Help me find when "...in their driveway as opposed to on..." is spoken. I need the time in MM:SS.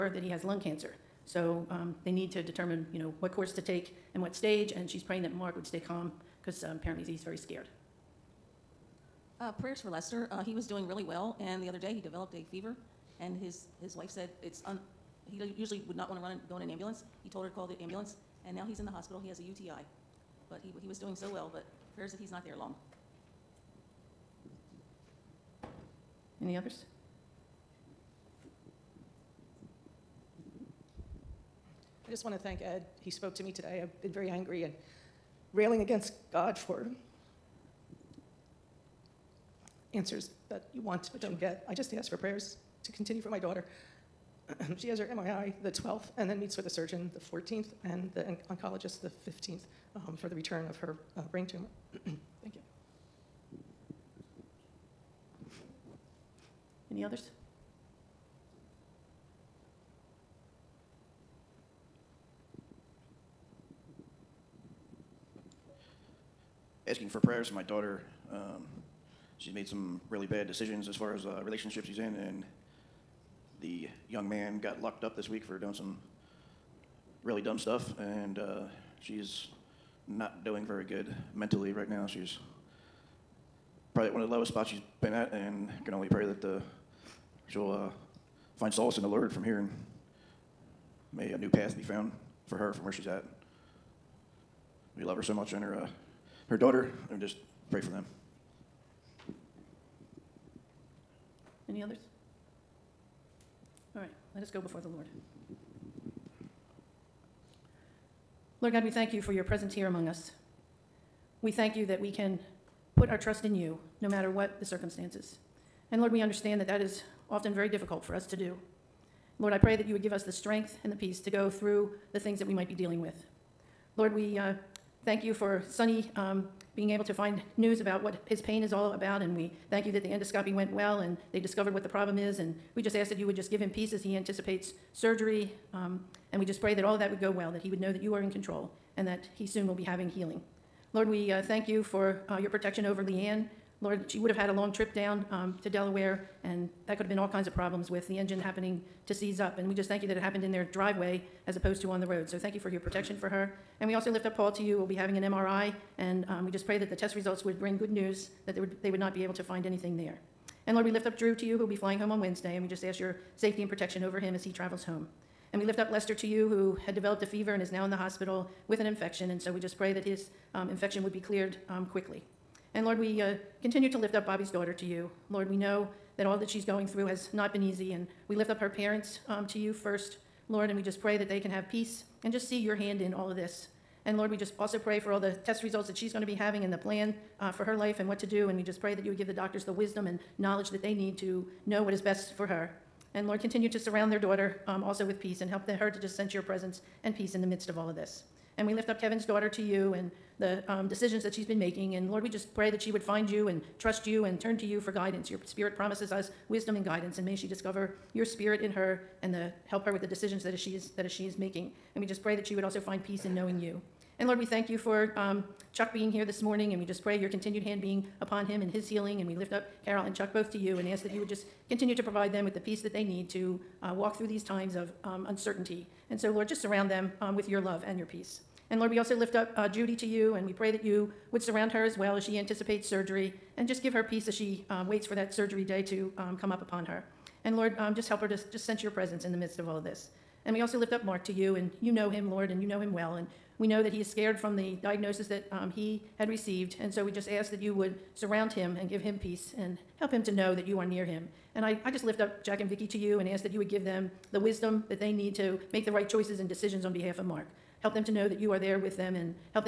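02:30.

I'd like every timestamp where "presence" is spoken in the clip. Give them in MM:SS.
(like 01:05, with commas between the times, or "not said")
01:49, 03:16, 03:58.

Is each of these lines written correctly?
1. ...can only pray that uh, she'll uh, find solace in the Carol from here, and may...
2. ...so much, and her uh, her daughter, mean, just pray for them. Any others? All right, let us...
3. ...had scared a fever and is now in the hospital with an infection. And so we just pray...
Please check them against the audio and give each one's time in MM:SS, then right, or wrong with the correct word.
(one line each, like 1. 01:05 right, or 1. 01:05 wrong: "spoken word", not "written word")
1. 01:25 wrong: "Lord", not "Carol"
2. 01:35 right
3. 02:46 wrong: "developed", not "scared".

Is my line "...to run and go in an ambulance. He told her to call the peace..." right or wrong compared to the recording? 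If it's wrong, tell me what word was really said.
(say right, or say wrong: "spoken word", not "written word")
wrong: "ambulance", not "peace".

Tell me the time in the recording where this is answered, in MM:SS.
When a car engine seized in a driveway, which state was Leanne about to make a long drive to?
02:25.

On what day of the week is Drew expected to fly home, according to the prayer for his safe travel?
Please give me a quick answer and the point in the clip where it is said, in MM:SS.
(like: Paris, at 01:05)
Wednesday, at 02:42.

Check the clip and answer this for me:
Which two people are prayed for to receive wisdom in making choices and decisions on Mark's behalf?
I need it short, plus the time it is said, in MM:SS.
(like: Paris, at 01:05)
Jack and Vicki, at 04:12.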